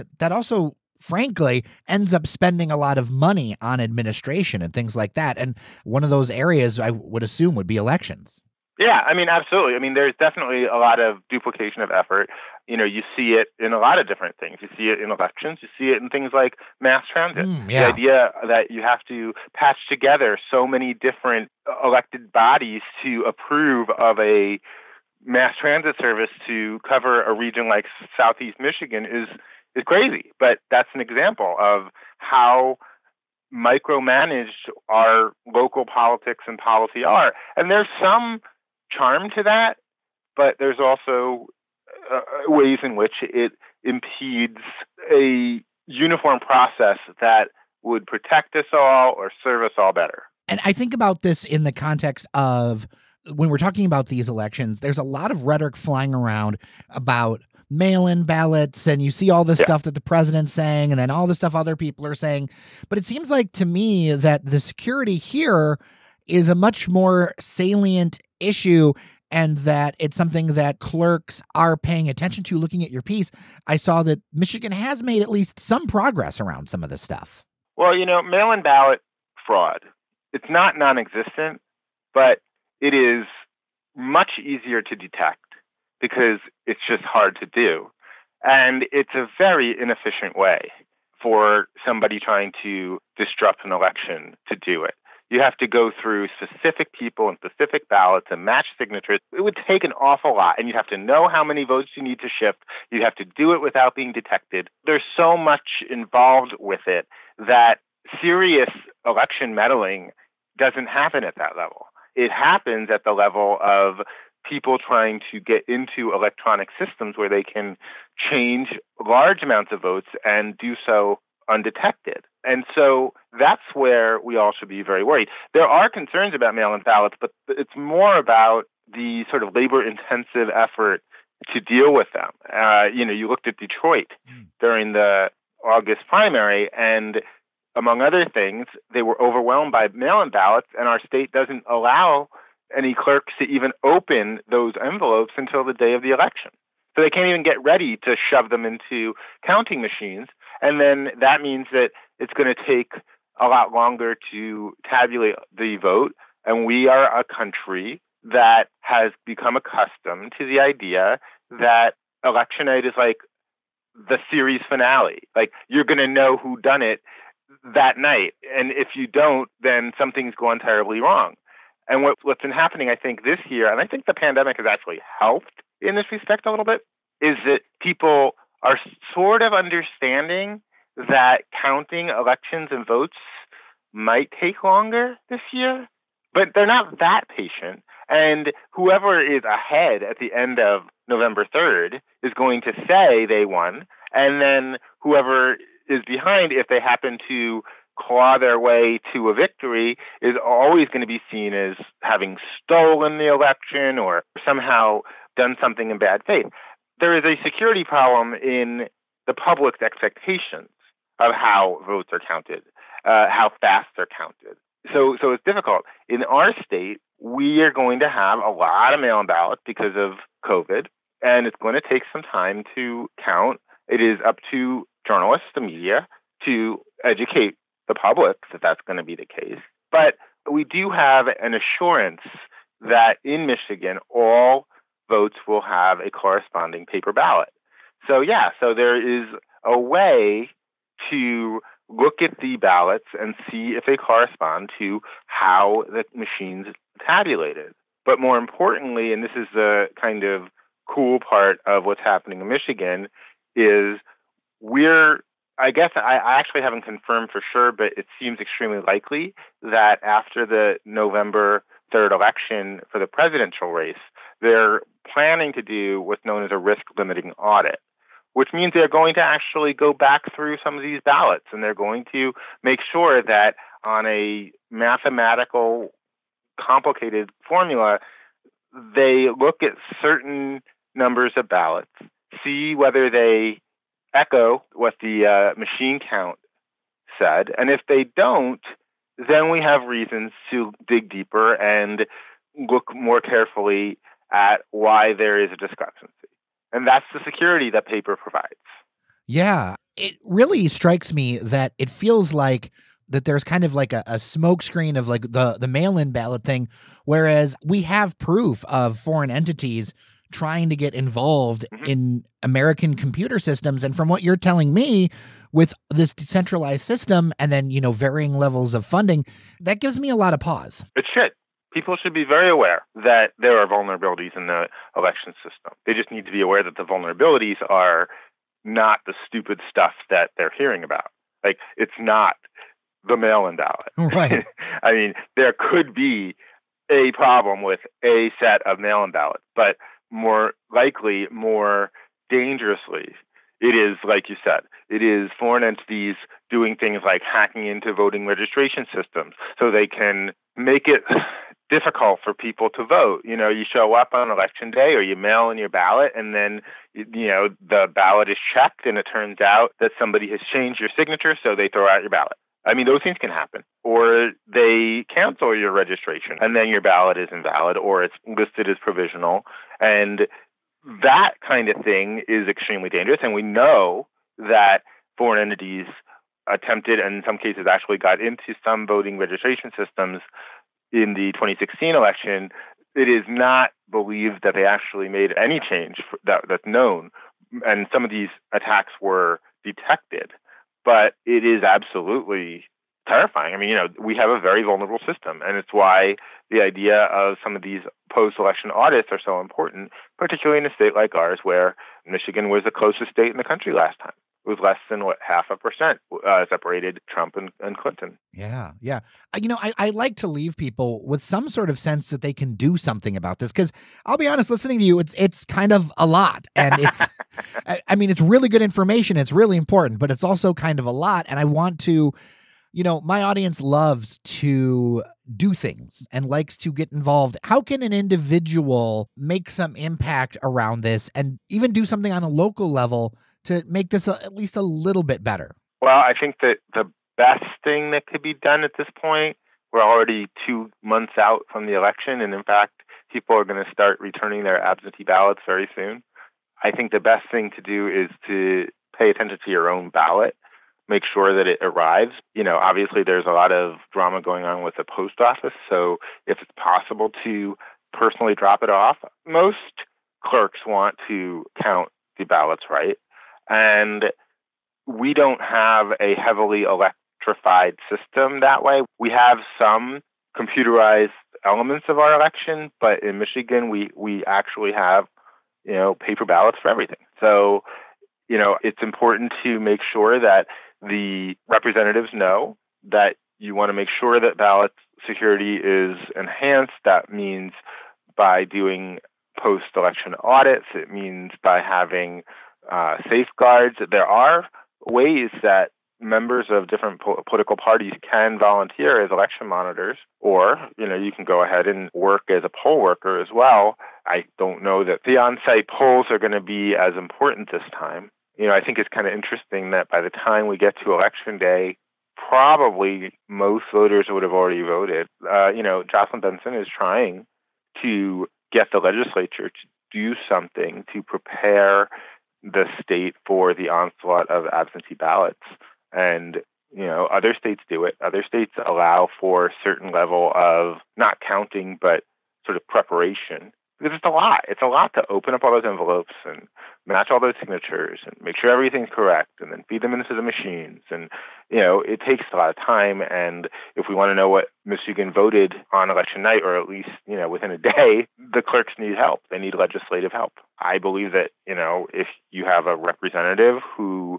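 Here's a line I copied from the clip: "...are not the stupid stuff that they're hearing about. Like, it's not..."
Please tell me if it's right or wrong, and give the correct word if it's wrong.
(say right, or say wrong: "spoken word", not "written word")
right.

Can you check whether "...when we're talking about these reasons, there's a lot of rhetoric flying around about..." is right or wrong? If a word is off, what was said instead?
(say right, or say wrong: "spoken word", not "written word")
wrong: "elections", not "reasons".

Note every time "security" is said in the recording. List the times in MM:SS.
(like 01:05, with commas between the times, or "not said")
01:04, 03:27, 04:57, 08:05.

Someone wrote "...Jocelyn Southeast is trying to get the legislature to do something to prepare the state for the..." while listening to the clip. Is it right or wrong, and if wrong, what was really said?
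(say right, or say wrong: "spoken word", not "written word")
wrong: "Benson", not "Southeast".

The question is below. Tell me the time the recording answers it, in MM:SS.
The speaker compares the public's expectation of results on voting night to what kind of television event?
02:44.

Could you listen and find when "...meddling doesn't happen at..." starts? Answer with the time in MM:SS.
01:49.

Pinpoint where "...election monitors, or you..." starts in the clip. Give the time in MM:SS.
08:19.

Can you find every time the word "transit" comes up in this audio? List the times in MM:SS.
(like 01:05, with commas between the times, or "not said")
00:17, 00:25.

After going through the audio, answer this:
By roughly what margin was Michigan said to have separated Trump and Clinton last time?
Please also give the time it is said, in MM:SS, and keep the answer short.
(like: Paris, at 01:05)
Half a percent, at 06:45.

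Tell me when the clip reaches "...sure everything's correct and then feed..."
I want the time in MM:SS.
08:58.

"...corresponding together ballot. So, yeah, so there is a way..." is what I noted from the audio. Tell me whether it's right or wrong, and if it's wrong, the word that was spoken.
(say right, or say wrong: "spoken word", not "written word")
wrong: "paper", not "together".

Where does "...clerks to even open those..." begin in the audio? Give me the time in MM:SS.
02:22.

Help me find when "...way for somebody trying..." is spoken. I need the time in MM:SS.
01:30.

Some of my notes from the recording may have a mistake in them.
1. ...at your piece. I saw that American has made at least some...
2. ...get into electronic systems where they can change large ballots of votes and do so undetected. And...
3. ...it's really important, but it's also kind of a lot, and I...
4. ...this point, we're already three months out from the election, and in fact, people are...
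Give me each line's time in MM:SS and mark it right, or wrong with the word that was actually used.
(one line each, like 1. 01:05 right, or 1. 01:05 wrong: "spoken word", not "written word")
1. 01:12 wrong: "Michigan", not "American"
2. 01:55 wrong: "amounts", not "ballots"
3. 06:59 right
4. 07:18 wrong: "two", not "three".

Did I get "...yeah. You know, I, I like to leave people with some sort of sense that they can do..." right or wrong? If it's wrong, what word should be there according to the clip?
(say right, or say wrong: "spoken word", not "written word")
right.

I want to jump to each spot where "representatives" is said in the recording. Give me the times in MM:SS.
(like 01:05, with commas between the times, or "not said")
08:01, 09:12.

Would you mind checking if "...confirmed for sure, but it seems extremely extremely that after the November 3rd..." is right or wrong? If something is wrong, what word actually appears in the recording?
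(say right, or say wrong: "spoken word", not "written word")
wrong: "likely", not "extremely".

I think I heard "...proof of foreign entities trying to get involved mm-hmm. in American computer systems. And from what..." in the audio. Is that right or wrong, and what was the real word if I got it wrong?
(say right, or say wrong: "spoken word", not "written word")
right.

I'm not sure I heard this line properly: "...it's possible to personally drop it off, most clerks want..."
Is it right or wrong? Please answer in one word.
right.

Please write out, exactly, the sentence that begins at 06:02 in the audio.
I mean, those things can happen.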